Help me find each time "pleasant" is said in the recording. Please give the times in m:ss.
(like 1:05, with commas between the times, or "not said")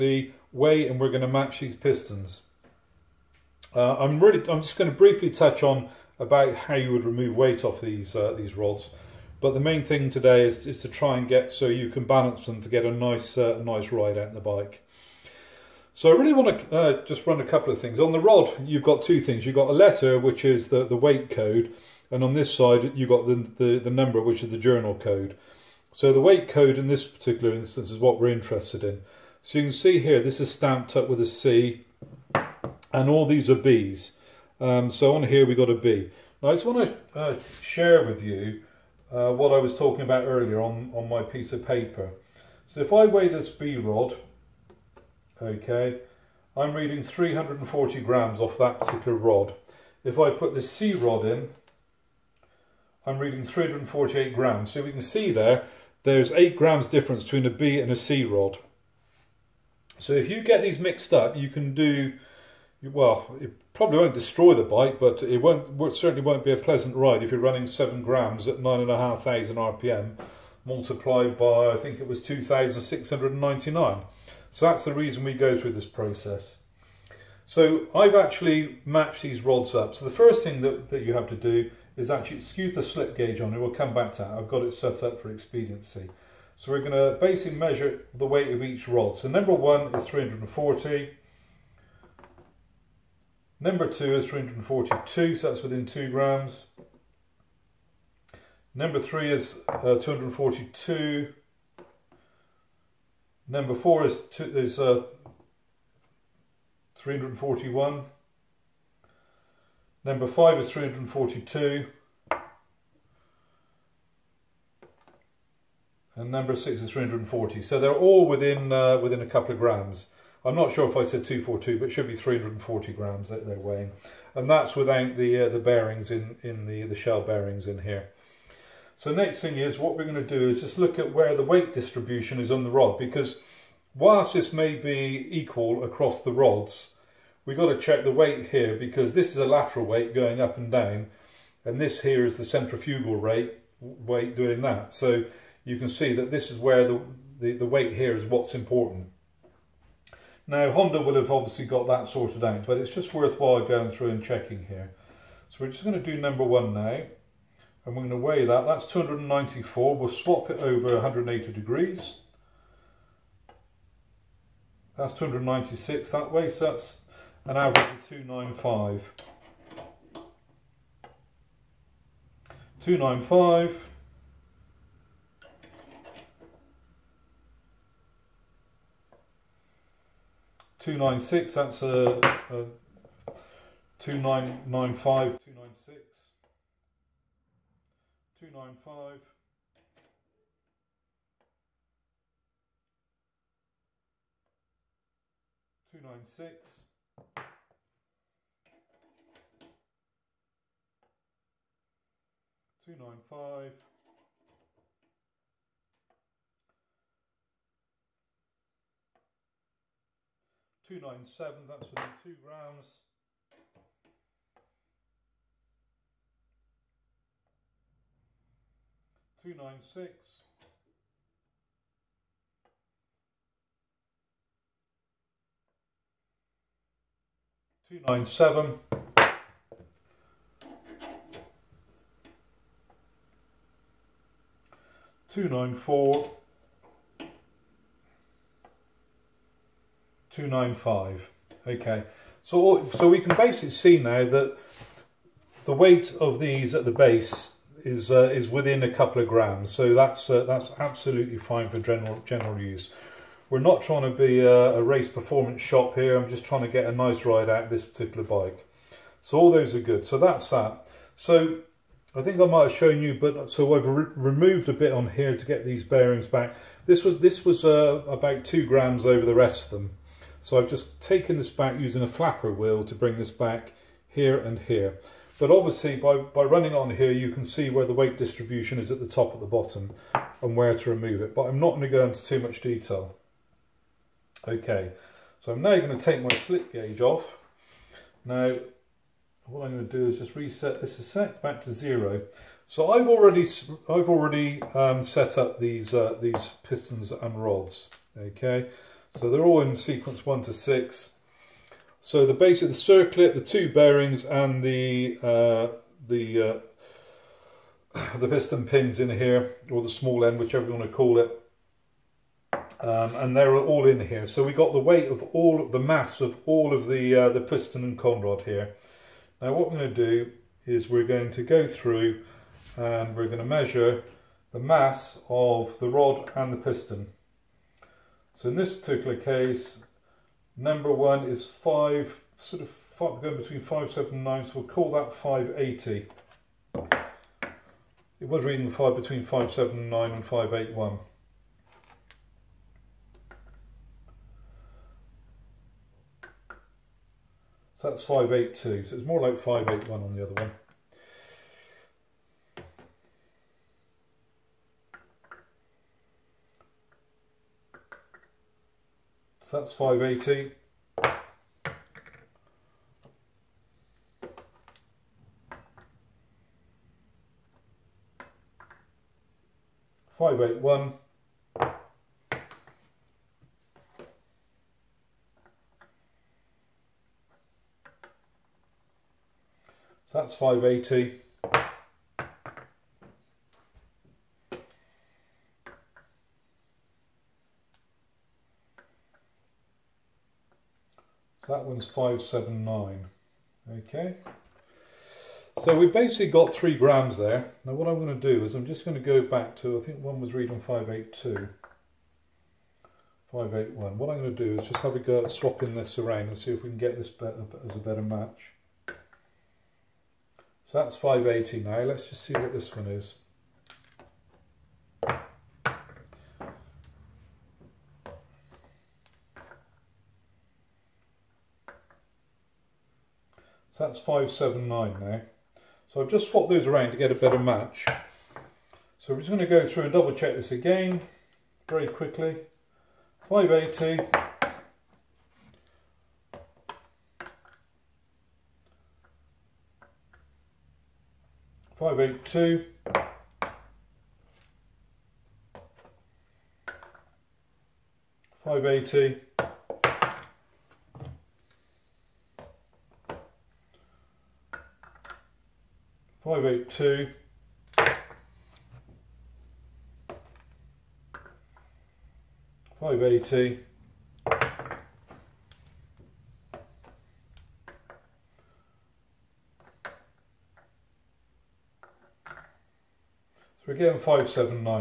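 1:06.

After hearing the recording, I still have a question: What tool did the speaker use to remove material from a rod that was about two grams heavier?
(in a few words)
flapper wheel.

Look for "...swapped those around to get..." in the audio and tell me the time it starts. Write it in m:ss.
7:06.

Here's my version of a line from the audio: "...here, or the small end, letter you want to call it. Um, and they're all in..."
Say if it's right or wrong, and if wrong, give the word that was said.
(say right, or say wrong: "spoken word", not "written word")
wrong: "whichever", not "letter".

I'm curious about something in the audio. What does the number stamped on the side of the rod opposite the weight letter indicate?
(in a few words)
journal code.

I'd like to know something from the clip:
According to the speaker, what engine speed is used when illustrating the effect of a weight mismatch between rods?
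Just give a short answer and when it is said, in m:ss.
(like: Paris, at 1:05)
9,500 RPM, at 1:08.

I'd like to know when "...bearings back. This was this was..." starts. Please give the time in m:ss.
4:25.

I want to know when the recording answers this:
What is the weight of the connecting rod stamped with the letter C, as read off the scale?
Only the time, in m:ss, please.
0:53.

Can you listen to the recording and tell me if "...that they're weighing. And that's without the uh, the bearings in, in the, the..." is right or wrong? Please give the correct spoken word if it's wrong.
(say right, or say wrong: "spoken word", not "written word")
right.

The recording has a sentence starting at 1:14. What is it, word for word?
So that's the reason we go through this process.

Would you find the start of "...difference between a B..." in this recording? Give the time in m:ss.
0:56.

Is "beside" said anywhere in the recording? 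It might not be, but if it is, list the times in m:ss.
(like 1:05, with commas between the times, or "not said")
not said.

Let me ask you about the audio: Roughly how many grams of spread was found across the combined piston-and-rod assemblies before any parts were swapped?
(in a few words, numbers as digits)
3 grams.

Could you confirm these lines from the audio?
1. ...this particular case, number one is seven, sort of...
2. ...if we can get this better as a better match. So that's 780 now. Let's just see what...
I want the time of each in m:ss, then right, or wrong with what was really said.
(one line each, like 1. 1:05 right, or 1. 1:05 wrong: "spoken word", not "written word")
1. 5:28 wrong: "five", not "seven"
2. 6:46 wrong: "580", not "780".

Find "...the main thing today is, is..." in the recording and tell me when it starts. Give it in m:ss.
0:09.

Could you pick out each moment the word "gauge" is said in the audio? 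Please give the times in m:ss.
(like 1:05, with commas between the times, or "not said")
1:23, 4:46.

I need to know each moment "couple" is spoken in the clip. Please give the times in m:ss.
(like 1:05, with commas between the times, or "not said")
0:17, 1:59, 4:08.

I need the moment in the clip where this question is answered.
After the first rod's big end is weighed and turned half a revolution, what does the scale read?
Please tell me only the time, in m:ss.
2:45.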